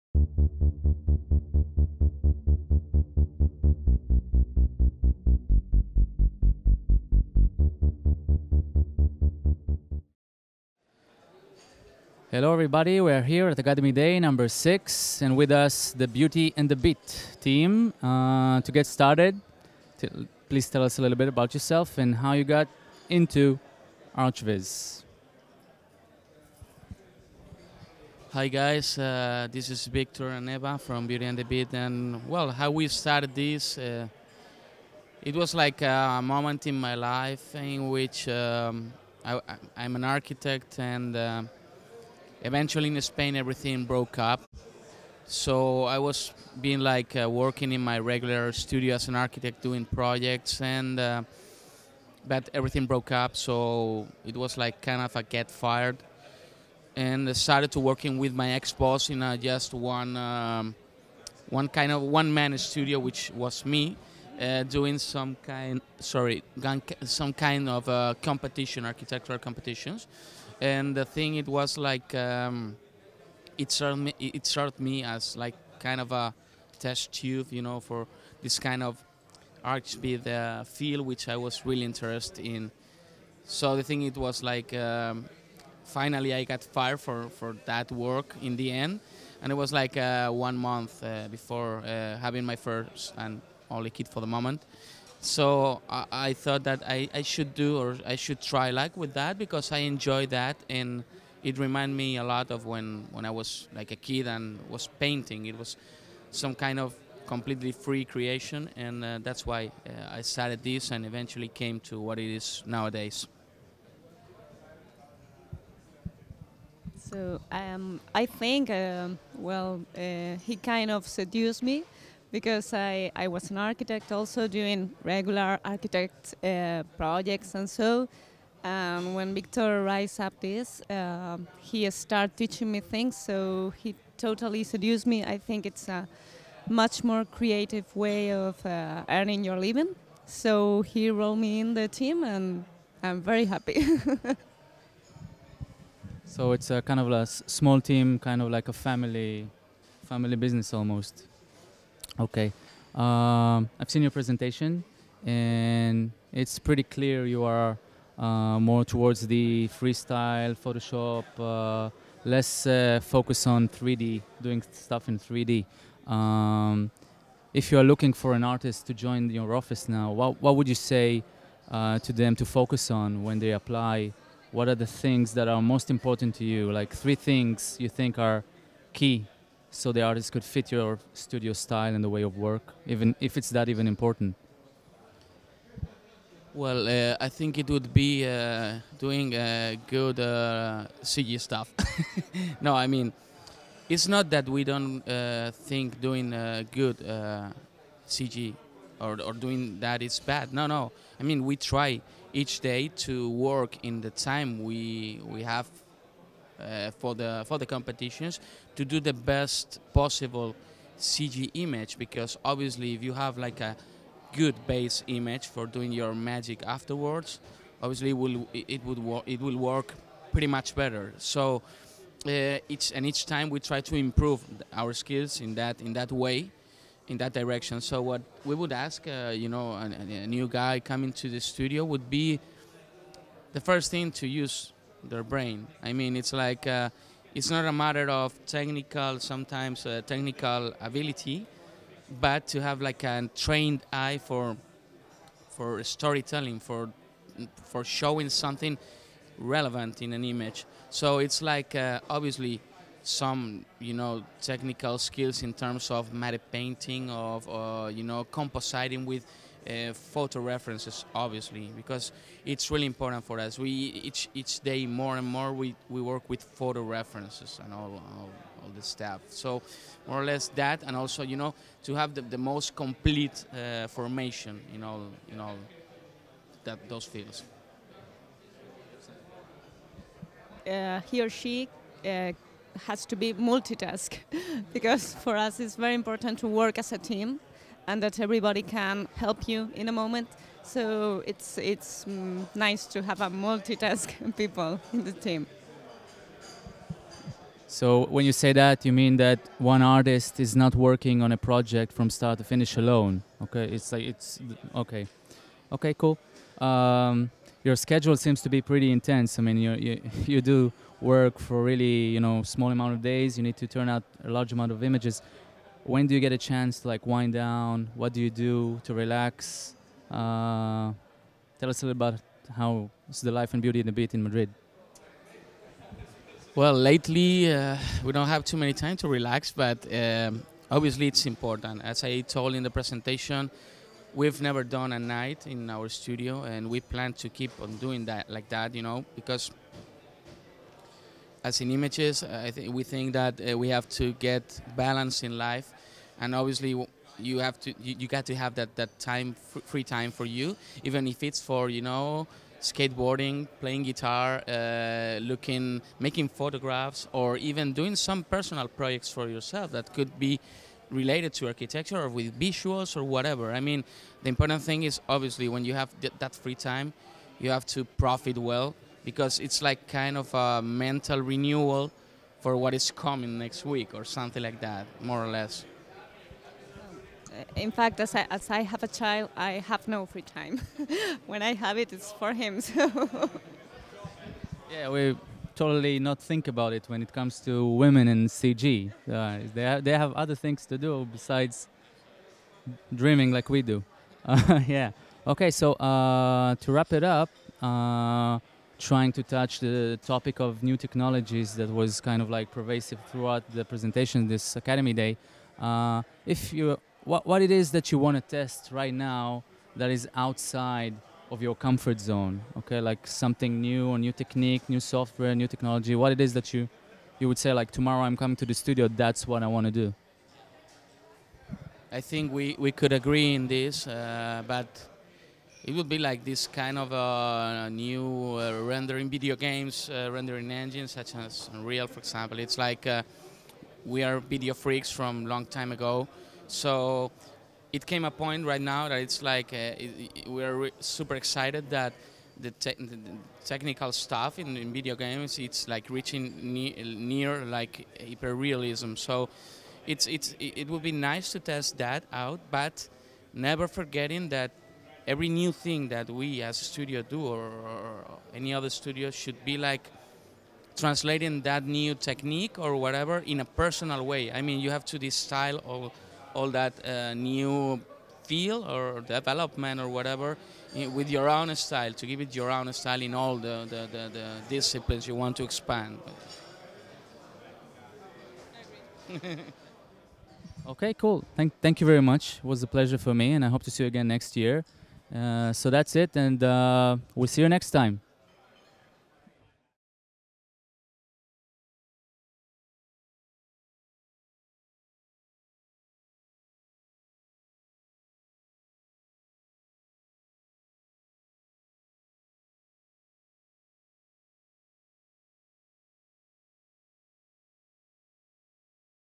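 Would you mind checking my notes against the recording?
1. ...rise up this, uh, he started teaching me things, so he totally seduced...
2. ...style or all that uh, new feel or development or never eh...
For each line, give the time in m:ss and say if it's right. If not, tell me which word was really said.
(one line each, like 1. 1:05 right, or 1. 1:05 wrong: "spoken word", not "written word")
1. 2:09 right
2. 7:45 wrong: "whatever", not "never".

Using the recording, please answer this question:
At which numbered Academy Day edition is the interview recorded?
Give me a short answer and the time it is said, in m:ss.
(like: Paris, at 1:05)
6, at 0:14.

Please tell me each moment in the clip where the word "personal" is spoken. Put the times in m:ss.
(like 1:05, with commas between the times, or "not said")
5:58, 7:43.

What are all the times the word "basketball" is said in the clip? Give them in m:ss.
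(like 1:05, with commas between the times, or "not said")
not said.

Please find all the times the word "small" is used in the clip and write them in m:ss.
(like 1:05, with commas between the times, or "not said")
2:27, 5:12.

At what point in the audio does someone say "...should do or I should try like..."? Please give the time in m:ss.
1:37.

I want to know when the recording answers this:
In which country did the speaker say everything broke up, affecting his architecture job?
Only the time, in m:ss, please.
0:43.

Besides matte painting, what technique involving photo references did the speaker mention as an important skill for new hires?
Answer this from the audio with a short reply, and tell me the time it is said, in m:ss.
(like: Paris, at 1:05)
Compositing, at 4:18.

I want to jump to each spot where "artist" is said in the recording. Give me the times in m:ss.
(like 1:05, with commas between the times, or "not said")
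2:48, 3:00, 4:59.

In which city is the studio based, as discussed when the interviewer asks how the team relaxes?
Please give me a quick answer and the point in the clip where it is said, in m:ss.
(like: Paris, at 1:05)
Madrid, at 5:24.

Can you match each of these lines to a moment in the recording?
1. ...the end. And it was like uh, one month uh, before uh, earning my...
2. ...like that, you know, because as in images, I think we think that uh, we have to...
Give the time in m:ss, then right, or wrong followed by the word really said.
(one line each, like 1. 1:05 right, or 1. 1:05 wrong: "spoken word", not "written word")
1. 1:28 wrong: "having", not "earning"
2. 5:38 right.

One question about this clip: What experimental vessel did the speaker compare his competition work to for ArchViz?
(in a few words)
A test tube.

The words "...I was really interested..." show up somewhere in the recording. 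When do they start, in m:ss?
1:21.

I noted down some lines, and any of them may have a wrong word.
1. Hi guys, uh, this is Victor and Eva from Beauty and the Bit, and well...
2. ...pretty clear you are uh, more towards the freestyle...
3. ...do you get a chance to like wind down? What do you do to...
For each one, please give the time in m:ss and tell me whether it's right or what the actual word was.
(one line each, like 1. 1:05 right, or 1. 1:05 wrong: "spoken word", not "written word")
1. 0:28 right
2. 2:36 right
3. 5:16 right.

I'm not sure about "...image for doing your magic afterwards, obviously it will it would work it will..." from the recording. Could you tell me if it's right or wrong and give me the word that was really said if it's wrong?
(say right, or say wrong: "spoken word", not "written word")
right.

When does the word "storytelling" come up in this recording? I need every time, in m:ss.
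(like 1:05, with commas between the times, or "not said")
4:05.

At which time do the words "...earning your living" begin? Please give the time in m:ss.
2:19.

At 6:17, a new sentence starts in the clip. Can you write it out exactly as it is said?
In fact, as I, as I have a child, I have no free time.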